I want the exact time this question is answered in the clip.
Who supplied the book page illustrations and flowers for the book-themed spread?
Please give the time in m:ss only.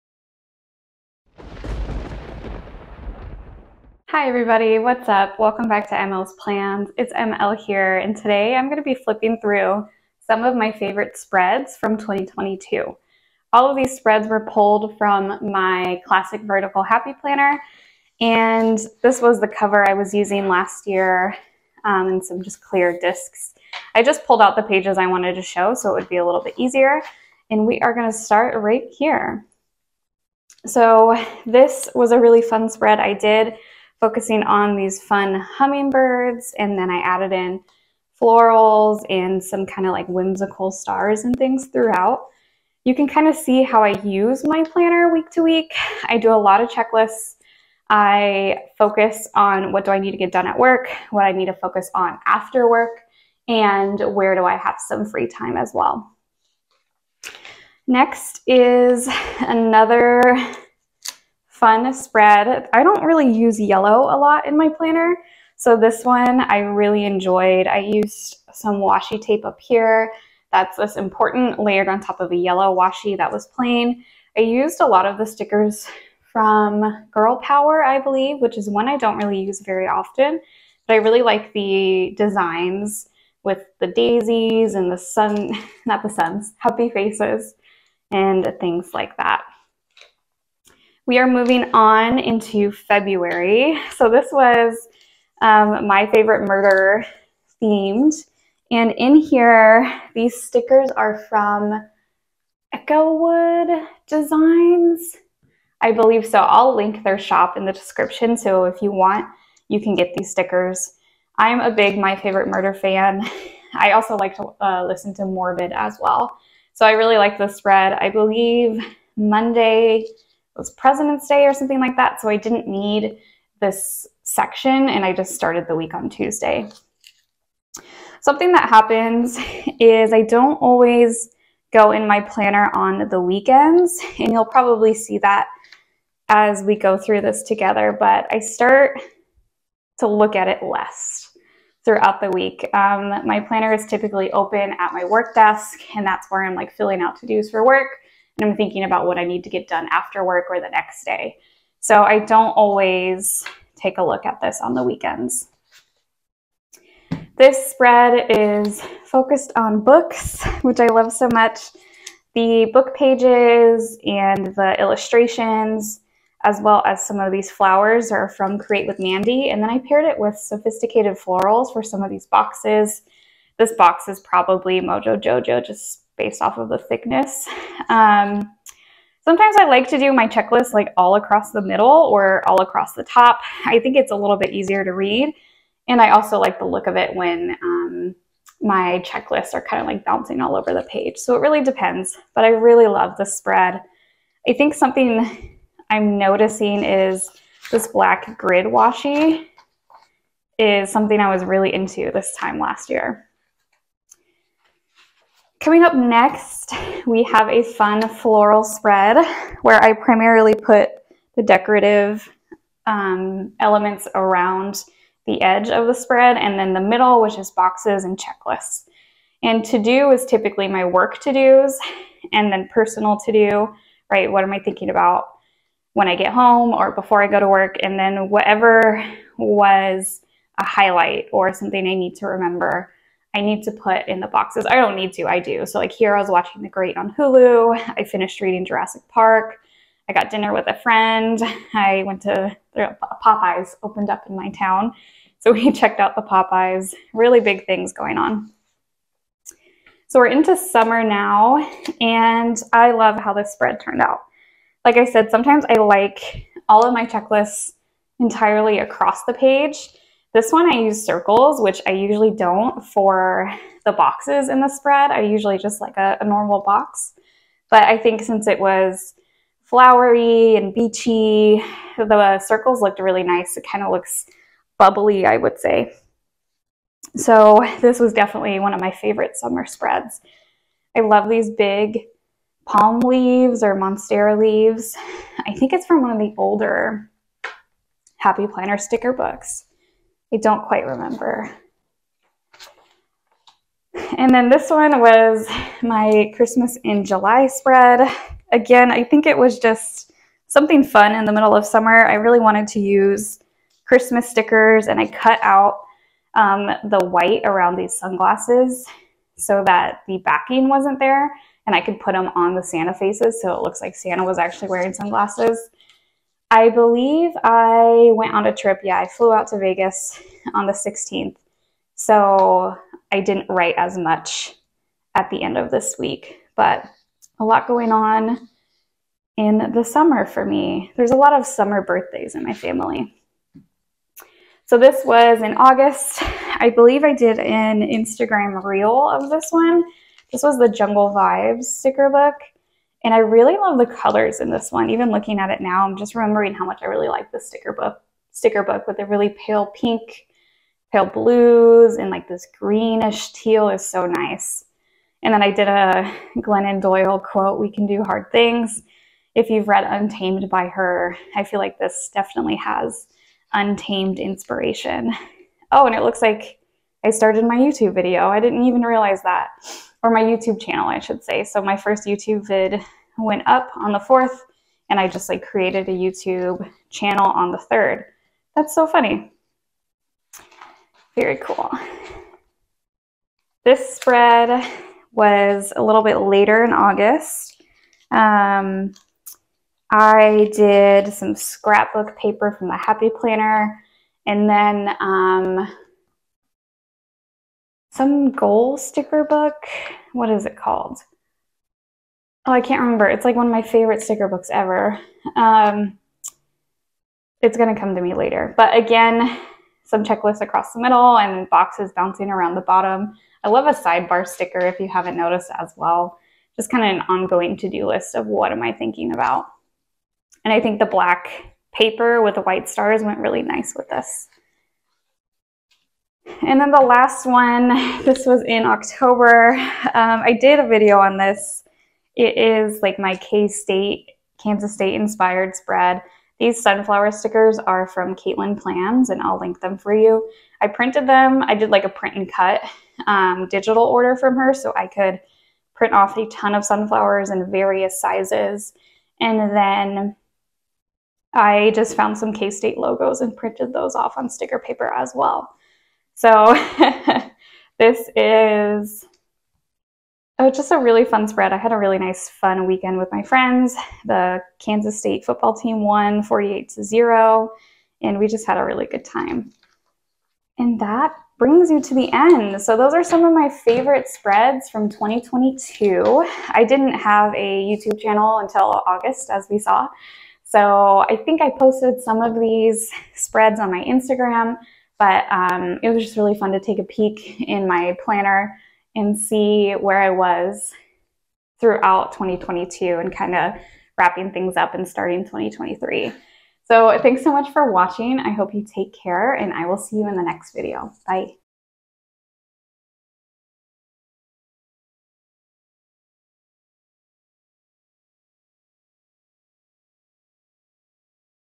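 2:48.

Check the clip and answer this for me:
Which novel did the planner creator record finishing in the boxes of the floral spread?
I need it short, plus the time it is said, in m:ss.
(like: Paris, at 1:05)
Jurassic Park, at 3:58.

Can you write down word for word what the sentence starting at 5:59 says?
If you've read Untamed by her, I feel like this definitely has untamed inspiration.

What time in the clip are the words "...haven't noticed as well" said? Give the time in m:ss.
6:54.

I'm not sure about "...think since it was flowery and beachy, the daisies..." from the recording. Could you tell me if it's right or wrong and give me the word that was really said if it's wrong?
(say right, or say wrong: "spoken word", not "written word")
wrong: "circles", not "daisies".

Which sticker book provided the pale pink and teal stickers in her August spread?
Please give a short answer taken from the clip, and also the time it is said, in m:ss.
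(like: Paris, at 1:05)
Jungle Vibes, at 5:40.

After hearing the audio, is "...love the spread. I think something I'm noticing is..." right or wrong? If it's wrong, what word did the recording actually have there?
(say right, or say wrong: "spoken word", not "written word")
right.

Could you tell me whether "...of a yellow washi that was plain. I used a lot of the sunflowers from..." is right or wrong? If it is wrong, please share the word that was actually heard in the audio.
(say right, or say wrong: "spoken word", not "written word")
wrong: "stickers", not "sunflowers".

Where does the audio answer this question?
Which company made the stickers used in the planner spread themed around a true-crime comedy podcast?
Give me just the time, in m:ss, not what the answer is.
1:42.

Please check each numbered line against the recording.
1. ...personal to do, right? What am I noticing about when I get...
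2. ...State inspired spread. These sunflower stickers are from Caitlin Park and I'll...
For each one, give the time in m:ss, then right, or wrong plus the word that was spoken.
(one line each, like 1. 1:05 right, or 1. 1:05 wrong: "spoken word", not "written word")
1. 3:42 wrong: "thinking", not "noticing"
2. 7:14 wrong: "Plans", not "Park".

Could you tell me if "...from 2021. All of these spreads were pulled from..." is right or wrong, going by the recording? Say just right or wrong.
wrong.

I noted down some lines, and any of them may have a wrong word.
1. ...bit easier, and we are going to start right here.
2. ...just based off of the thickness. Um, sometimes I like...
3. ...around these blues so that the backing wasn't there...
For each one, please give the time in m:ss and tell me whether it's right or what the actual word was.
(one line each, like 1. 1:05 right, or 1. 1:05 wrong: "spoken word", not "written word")
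1. 0:26 right
2. 2:55 right
3. 5:07 wrong: "sunglasses", not "blues".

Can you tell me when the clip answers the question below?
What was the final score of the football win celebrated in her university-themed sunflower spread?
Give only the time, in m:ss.
7:46.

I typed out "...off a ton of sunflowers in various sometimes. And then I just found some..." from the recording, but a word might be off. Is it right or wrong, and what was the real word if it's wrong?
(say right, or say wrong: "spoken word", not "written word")
wrong: "sizes", not "sometimes".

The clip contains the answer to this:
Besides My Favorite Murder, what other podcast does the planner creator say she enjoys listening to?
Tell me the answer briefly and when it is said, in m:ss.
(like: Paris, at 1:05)
Morbid, at 1:55.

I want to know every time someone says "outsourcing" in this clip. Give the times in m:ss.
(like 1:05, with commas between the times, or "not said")
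not said.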